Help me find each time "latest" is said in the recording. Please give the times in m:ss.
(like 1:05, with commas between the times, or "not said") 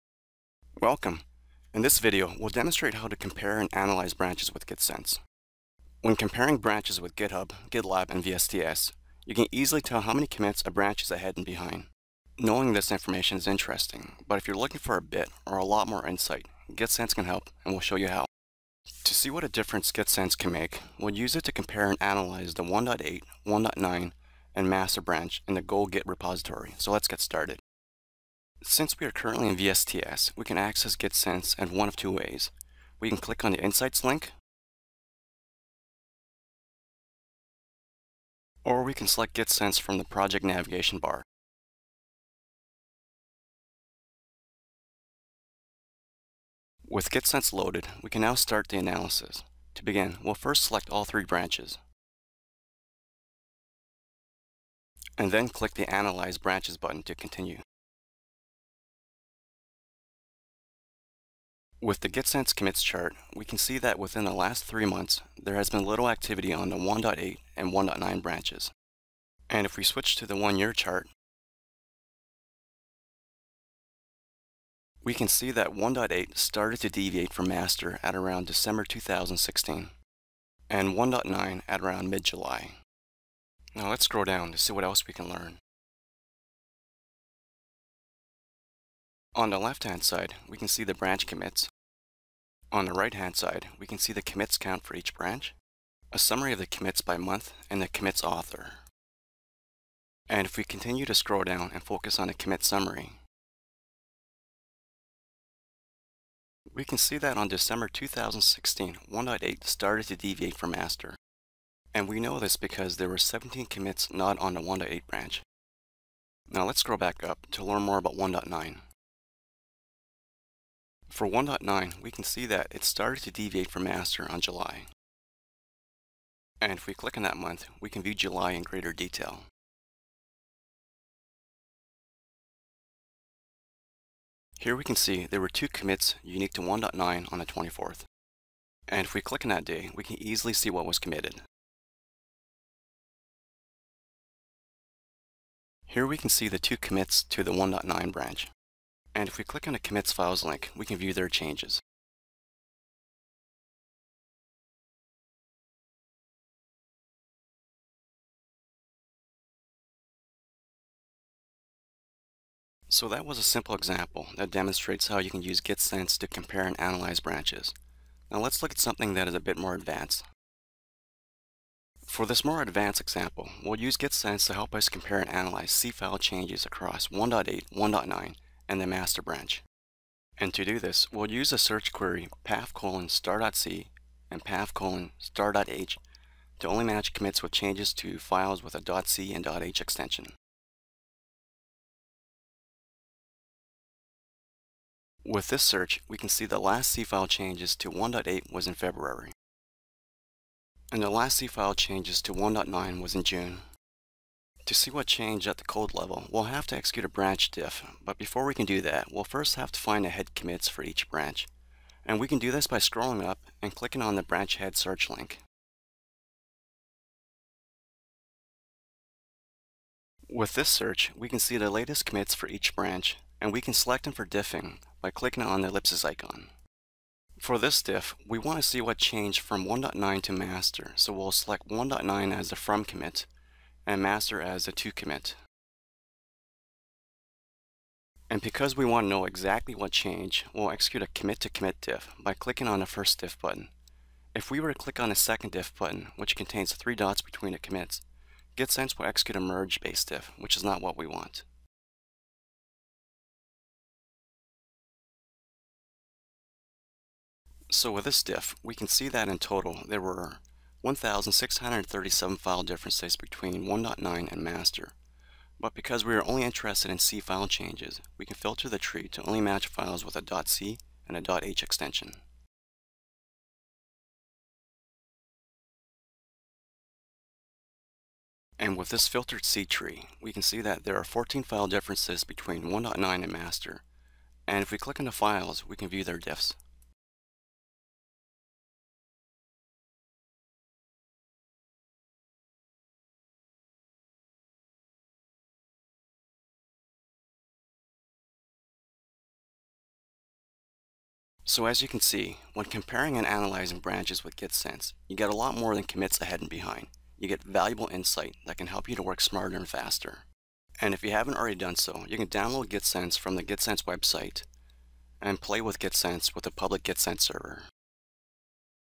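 3:41.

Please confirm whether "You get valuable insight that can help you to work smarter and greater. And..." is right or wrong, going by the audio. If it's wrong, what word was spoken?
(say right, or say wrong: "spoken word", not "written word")
wrong: "faster", not "greater".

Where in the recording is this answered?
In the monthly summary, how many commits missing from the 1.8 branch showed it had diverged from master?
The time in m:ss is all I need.
1:53.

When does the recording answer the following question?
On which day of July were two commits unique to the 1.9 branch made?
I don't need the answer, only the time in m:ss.
2:17.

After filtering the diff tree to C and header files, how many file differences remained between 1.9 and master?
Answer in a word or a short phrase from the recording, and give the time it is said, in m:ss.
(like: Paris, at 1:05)
14, at 4:41.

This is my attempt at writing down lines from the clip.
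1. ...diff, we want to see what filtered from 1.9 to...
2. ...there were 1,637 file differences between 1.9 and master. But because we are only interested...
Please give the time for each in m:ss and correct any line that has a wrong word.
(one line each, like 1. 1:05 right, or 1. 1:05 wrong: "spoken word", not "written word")
1. 3:47 wrong: "changed", not "filtered"
2. 4:19 right.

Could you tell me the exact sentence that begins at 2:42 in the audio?
So that was a simple example that demonstrates how you can use GitSense to compare and analyze branches.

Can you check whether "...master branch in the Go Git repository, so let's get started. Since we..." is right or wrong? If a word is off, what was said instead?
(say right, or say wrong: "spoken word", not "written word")
right.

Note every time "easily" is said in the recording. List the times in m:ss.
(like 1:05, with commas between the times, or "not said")
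0:09, 2:20.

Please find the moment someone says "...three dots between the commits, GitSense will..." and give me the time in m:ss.
4:06.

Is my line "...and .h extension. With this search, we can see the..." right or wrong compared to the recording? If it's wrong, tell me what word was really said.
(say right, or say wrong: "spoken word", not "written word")
right.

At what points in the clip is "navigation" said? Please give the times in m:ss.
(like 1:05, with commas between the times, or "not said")
0:40.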